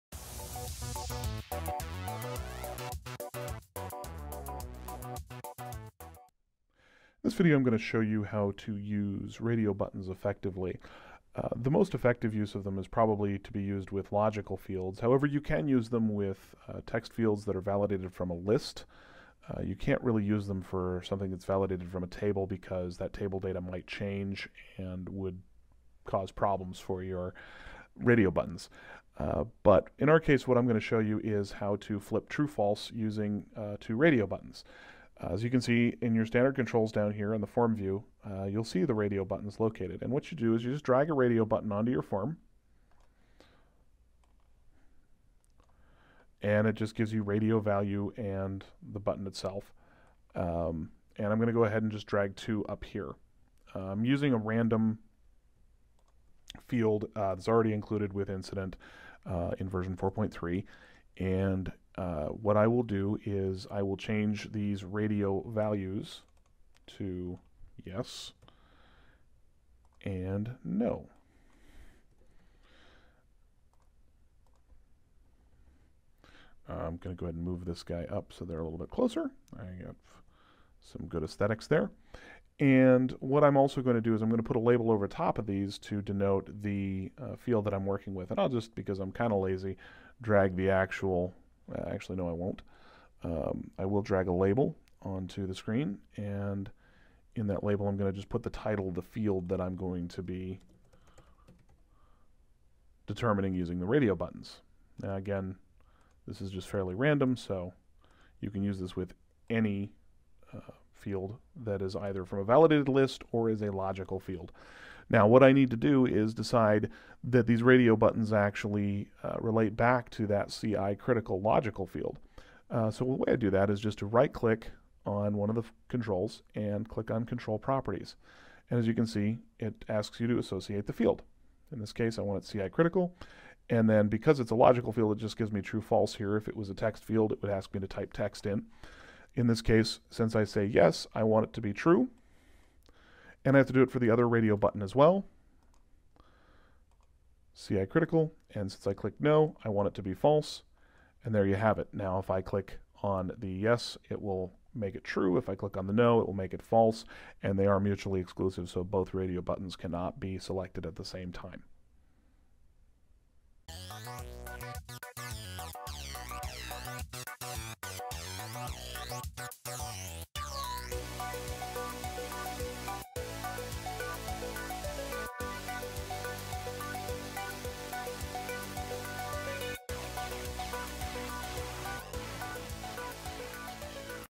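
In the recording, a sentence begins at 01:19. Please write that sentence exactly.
I have some good aesthetics there.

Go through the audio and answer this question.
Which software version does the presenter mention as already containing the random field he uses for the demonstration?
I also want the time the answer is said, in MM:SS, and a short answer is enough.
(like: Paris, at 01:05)
4.3, at 00:59.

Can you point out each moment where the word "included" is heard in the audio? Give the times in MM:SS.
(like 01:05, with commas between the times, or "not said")
00:57.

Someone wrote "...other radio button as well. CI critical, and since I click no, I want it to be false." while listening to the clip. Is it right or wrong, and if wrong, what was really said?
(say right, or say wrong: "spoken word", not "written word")
right.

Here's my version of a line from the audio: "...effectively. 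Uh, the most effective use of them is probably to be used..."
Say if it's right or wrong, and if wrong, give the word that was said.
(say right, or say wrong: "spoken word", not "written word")
right.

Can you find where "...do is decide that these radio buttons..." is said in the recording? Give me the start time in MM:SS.
01:55.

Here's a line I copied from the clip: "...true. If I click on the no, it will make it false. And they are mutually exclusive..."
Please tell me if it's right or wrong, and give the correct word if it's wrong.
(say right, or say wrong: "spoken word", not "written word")
right.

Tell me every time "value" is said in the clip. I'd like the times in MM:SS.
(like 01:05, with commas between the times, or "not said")
00:47, 01:05.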